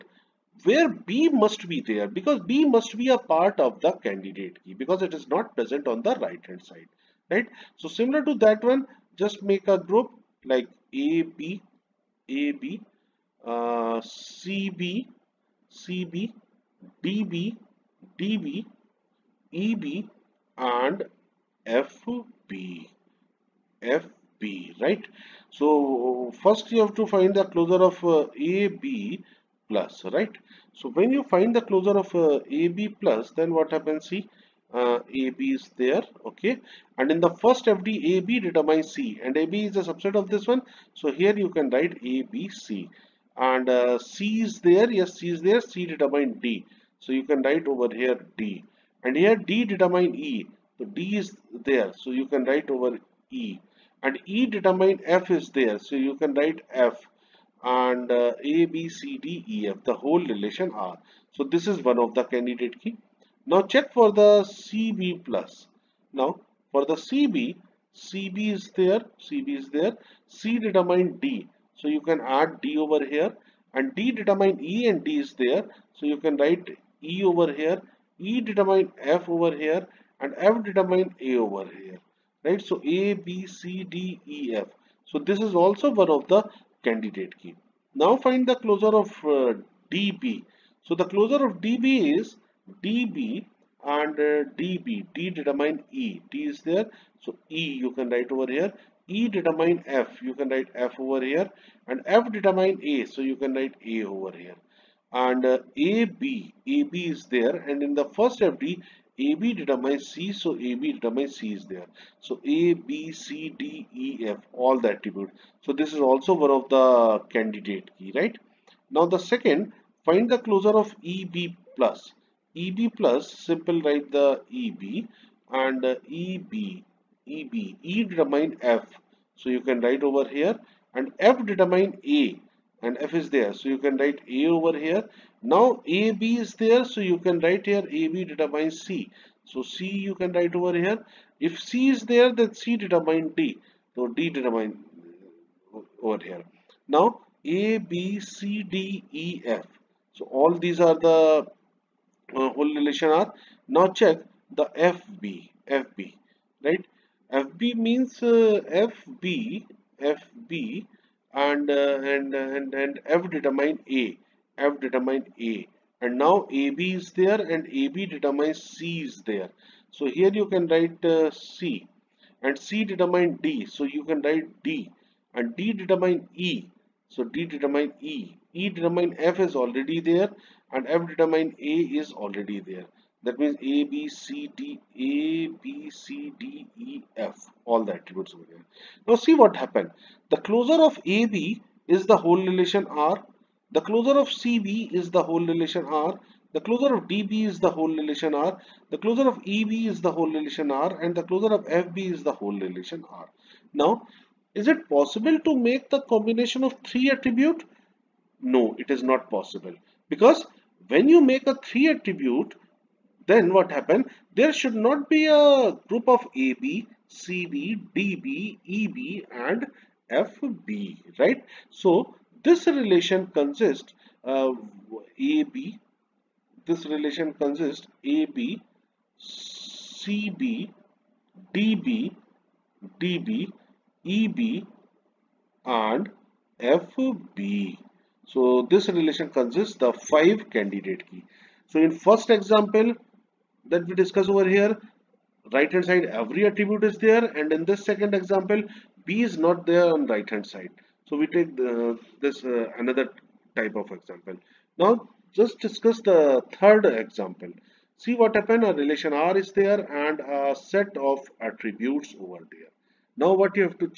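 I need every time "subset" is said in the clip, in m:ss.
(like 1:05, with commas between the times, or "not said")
0:39.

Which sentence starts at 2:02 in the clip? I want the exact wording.
EB plus, simple write the EB and EB, EB, E determine F.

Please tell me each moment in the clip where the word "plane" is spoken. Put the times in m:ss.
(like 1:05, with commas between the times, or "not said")
not said.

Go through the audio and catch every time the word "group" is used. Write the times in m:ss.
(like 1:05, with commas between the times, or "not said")
0:09, 3:35.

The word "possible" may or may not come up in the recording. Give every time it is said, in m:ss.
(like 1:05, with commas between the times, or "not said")
3:24, 3:29.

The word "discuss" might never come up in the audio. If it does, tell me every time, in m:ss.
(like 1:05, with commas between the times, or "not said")
4:04, 4:15.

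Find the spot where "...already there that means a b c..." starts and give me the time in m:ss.
3:02.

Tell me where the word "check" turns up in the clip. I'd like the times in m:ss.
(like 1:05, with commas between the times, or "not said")
1:03, 2:34.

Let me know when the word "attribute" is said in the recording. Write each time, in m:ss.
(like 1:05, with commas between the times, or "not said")
1:54, 3:07, 3:27, 3:31, 4:06, 4:21.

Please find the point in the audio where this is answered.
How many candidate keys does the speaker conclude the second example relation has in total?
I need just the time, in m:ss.
3:59.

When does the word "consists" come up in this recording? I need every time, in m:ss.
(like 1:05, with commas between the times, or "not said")
3:43, 3:47, 3:59.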